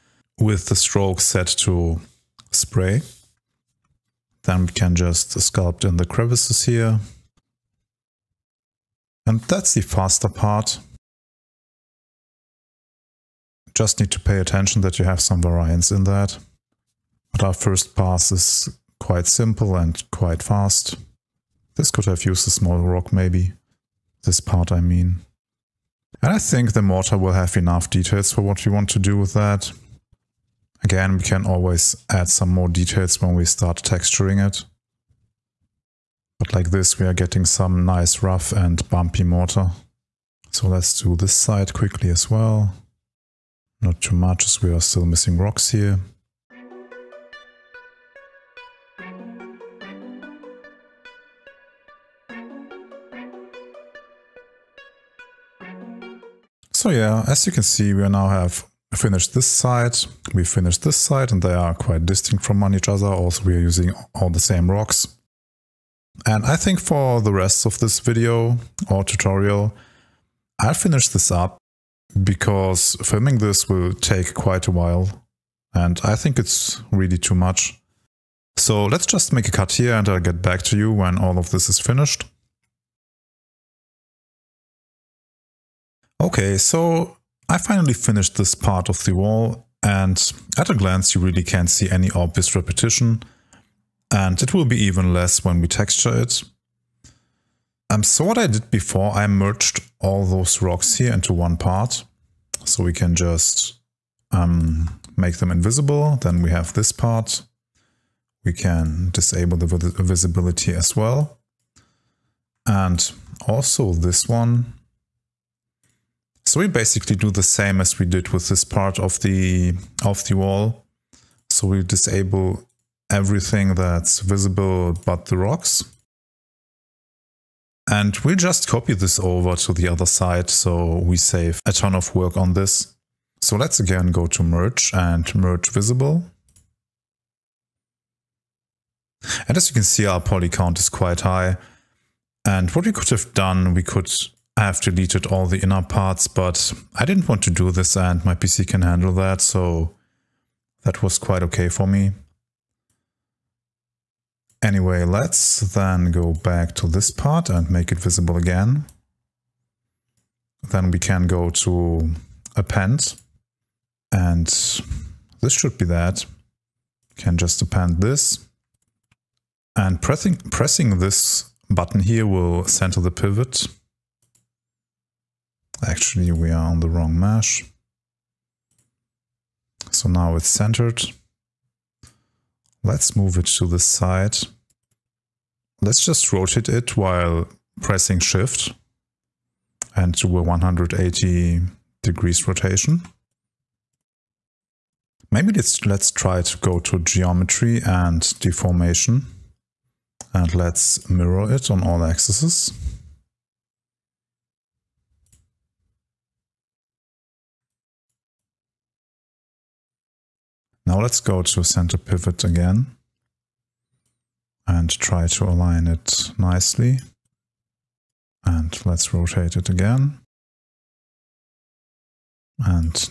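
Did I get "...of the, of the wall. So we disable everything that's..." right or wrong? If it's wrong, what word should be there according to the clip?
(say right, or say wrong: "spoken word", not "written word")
right.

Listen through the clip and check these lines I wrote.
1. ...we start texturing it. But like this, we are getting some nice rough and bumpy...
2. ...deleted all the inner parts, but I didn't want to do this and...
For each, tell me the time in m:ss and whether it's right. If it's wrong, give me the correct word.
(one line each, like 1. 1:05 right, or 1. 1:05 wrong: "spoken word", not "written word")
1. 0:33 right
2. 2:24 right.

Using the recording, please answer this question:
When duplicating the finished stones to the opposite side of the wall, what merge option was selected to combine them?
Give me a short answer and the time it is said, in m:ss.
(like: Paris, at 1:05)
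Merge visible, at 2:15.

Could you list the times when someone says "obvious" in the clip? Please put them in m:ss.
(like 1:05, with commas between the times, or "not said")
1:32.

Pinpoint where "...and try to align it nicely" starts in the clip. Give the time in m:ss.
3:34.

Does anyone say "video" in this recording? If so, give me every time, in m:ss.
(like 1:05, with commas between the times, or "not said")
1:07.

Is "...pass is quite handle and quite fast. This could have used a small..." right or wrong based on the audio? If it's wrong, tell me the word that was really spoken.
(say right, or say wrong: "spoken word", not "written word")
wrong: "simple", not "handle".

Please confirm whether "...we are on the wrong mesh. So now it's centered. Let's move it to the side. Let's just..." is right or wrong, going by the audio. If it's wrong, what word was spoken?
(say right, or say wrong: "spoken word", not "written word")
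right.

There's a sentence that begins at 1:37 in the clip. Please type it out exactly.
Um, so what I did before, I merged all those rocks here into one part.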